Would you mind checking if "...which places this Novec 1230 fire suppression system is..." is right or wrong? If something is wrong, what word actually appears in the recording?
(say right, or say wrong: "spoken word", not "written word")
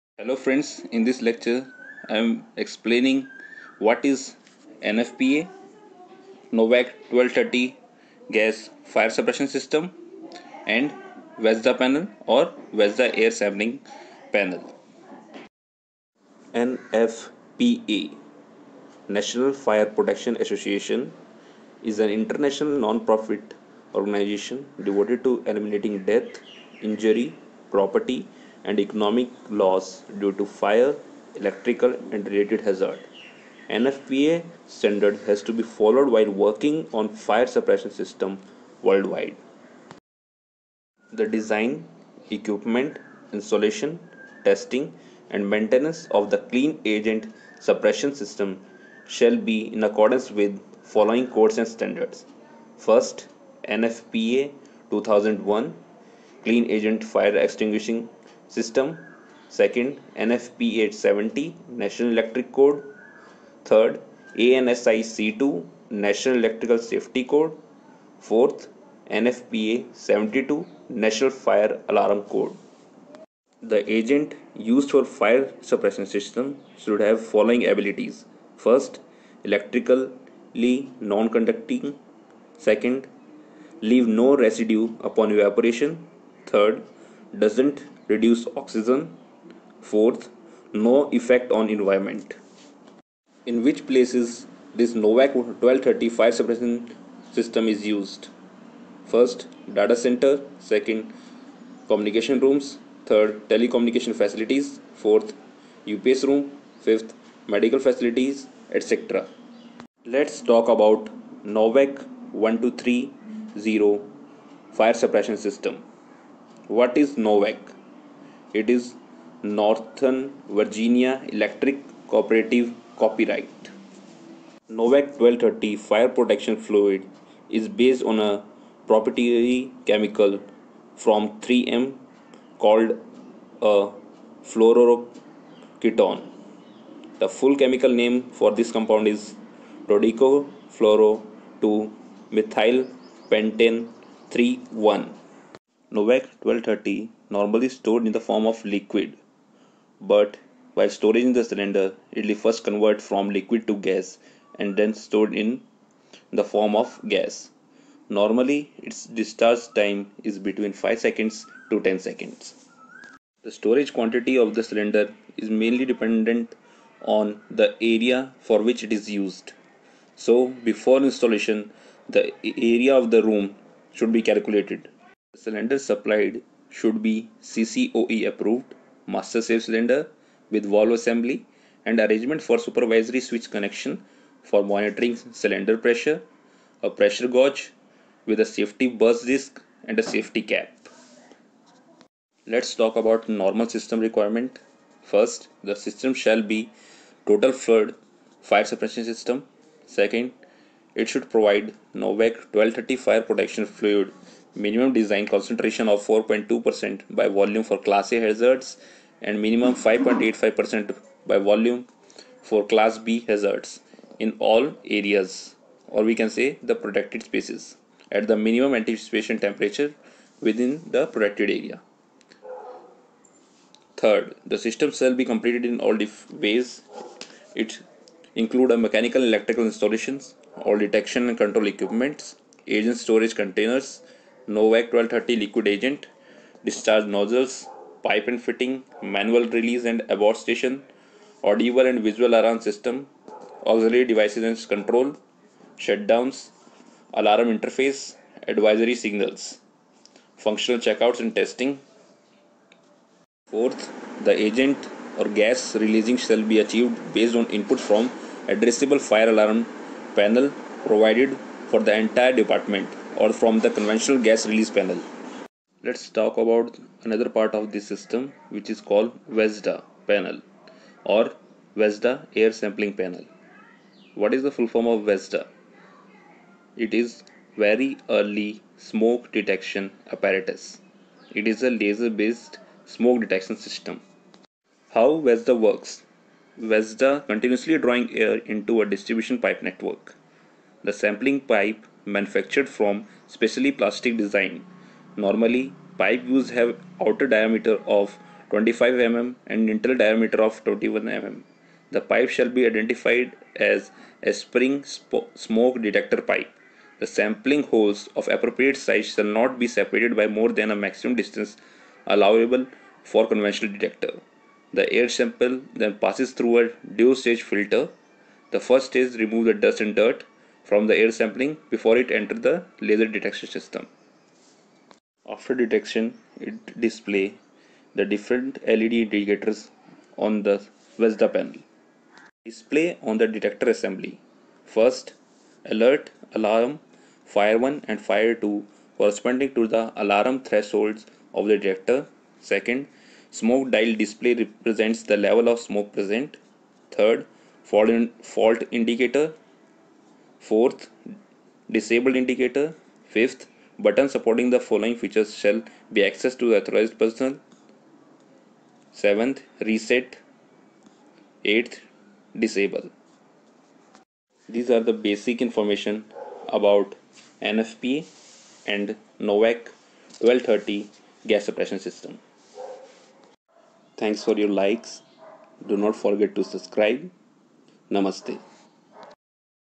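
right.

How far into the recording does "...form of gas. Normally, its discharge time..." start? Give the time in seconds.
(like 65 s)
156 s.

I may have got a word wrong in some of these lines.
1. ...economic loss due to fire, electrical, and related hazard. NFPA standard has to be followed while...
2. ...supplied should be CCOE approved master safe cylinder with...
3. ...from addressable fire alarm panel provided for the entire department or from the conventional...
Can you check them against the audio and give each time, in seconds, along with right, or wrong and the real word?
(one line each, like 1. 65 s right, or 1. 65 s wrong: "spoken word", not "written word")
1. 28 s right
2. 175 s right
3. 257 s right.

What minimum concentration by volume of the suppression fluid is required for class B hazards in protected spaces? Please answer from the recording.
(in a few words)
5.85%.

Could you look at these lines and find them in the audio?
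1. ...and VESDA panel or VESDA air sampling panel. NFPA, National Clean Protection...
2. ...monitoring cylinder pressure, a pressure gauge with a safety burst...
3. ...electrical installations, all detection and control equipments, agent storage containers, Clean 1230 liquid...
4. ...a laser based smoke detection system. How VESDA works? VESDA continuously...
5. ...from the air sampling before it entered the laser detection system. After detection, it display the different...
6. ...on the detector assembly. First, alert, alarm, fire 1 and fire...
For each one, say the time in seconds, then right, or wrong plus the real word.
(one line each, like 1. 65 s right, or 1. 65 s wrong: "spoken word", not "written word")
1. 10 s wrong: "Fire", not "Clean"
2. 184 s right
3. 229 s wrong: "Novec", not "Clean"
4. 281 s right
5. 320 s right
6. 333 s right.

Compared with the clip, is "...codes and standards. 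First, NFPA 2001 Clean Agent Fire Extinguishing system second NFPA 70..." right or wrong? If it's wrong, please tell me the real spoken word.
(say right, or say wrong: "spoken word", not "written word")
right.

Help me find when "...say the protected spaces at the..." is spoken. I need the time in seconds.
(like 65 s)
216 s.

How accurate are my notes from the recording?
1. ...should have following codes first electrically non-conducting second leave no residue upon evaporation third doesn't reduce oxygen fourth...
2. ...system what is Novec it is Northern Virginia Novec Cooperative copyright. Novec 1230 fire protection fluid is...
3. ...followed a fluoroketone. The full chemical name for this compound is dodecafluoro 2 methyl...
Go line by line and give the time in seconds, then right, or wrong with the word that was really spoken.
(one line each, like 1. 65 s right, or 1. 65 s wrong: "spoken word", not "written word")
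1. 76 s wrong: "abilities", not "codes"
2. 115 s wrong: "Electric", not "Novec"
3. 132 s wrong: "called", not "followed".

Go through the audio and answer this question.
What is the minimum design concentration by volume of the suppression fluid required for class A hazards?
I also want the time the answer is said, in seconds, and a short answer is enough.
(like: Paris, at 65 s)
4.2%, at 206 s.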